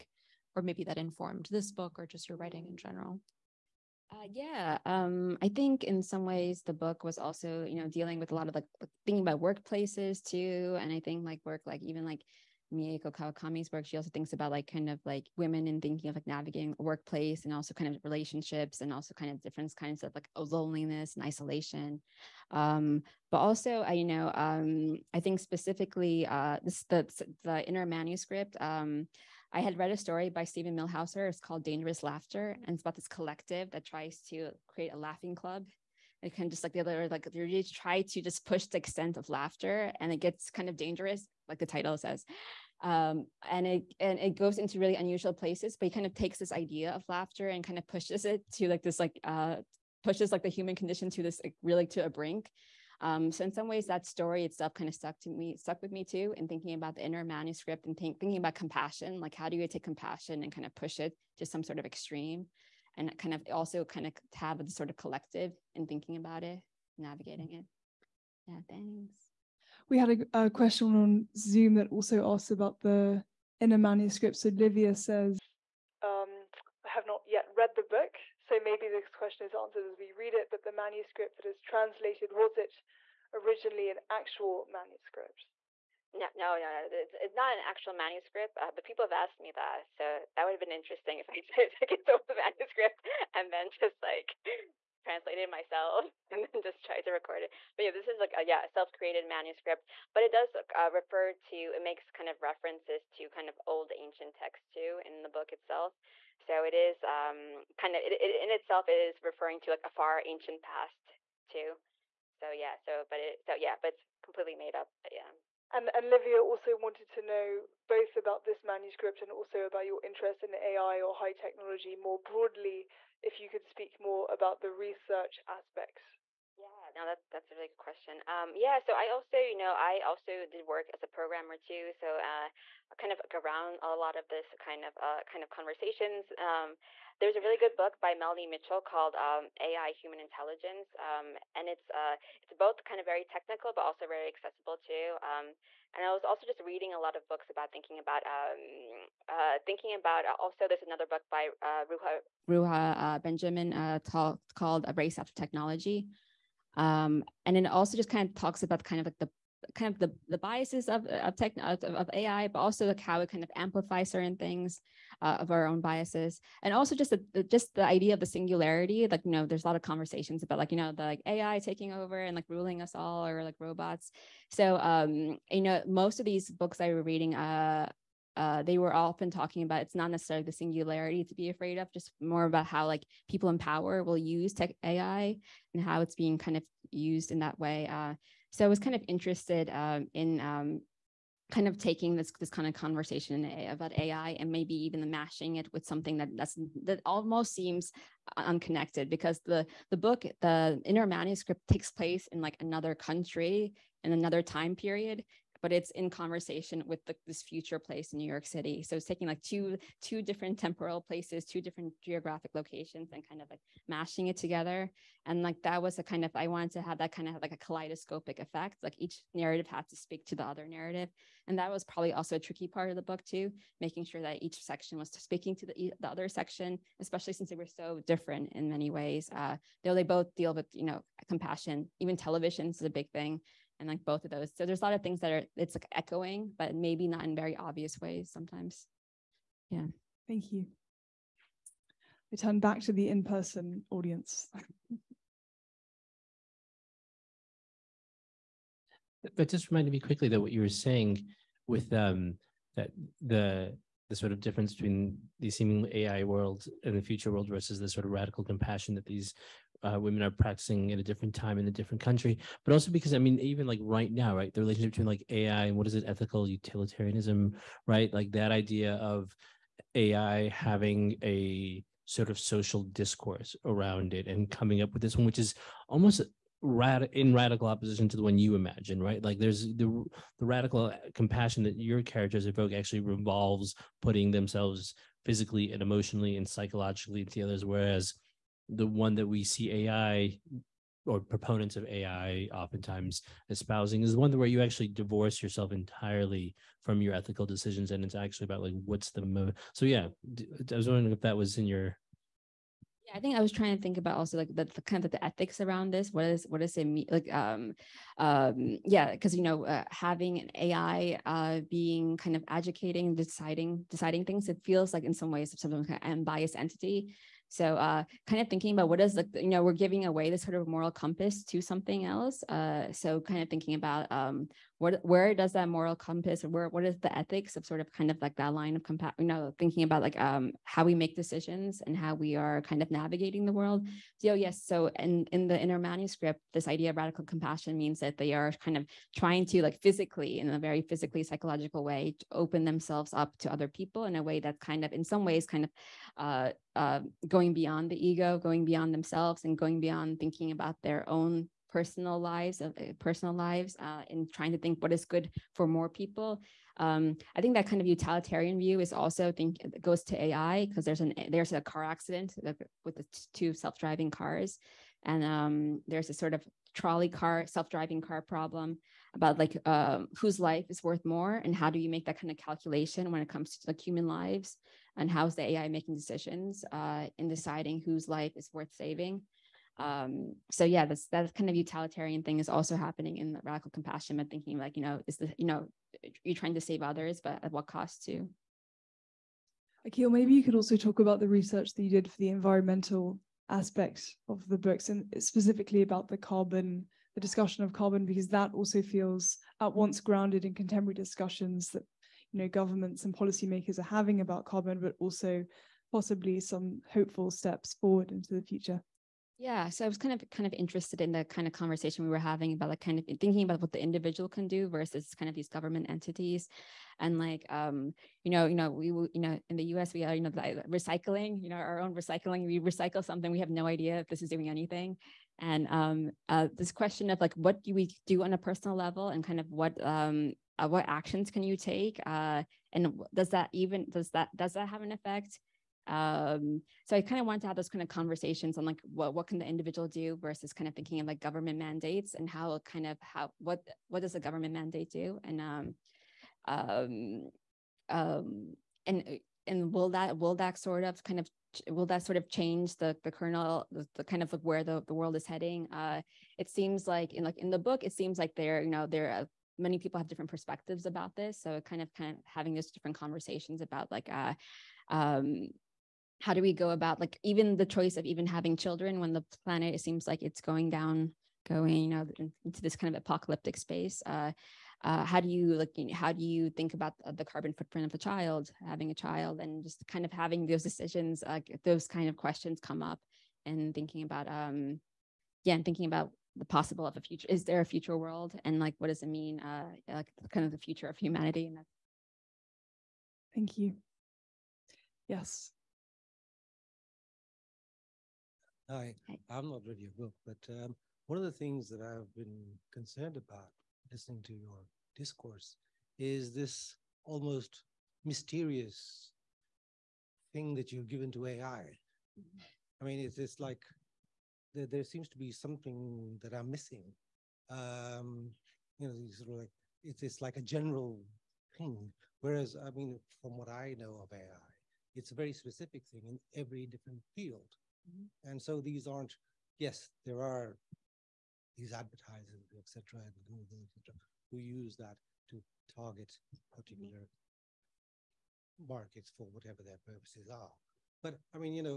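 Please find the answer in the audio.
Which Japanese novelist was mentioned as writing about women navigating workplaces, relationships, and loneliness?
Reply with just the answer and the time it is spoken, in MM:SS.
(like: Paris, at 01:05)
Mieko Kawakami, at 00:12.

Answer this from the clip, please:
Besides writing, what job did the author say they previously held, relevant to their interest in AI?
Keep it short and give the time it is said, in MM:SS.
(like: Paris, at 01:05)
programmer, at 02:11.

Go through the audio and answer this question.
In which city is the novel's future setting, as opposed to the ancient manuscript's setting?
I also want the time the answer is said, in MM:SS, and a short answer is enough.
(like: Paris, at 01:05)
New York City, at 03:28.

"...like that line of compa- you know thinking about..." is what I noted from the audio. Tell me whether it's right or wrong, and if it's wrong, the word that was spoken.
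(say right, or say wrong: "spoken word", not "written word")
right.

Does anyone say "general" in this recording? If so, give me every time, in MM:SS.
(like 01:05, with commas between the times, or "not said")
00:02, 08:40.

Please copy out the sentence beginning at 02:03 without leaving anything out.
If you could speak more about the research aspects.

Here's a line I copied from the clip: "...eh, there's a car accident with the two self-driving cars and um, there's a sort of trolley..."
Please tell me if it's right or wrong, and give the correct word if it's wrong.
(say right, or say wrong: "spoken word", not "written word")
right.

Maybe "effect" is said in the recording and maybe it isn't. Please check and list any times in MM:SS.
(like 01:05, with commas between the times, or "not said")
03:38, 07:14.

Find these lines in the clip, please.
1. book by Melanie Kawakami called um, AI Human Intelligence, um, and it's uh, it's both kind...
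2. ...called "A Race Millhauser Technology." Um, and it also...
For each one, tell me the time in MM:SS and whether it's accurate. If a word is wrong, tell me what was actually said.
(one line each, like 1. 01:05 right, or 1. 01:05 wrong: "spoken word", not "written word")
1. 02:17 wrong: "Mitchell", not "Kawakami"
2. 02:34 wrong: "After", not "Millhauser".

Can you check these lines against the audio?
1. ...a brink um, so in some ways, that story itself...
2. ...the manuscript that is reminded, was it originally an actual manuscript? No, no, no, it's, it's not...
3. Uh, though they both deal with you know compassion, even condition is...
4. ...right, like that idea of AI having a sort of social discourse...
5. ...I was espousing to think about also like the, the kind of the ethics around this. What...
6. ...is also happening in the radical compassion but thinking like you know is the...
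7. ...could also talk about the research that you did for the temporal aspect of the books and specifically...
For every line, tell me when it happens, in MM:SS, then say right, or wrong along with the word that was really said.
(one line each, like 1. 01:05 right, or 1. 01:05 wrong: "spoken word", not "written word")
1. 00:52 right
2. 01:20 wrong: "translated", not "reminded"
3. 03:49 wrong: "television", not "condition"
4. 04:27 right
5. 05:03 wrong: "trying", not "espousing"
6. 06:22 right
7. 06:30 wrong: "environmental", not "temporal".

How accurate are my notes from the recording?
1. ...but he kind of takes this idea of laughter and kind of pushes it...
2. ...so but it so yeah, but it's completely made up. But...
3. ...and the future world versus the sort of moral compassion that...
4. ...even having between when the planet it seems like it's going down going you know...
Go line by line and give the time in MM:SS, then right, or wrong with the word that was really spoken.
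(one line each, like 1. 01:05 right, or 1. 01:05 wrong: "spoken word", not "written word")
1. 00:45 right
2. 01:52 right
3. 04:16 wrong: "radical", not "moral"
4. 07:48 wrong: "children", not "between".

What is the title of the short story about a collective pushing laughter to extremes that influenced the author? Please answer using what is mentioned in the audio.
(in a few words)
Dangerous Laughter.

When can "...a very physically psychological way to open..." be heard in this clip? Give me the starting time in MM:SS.
05:40.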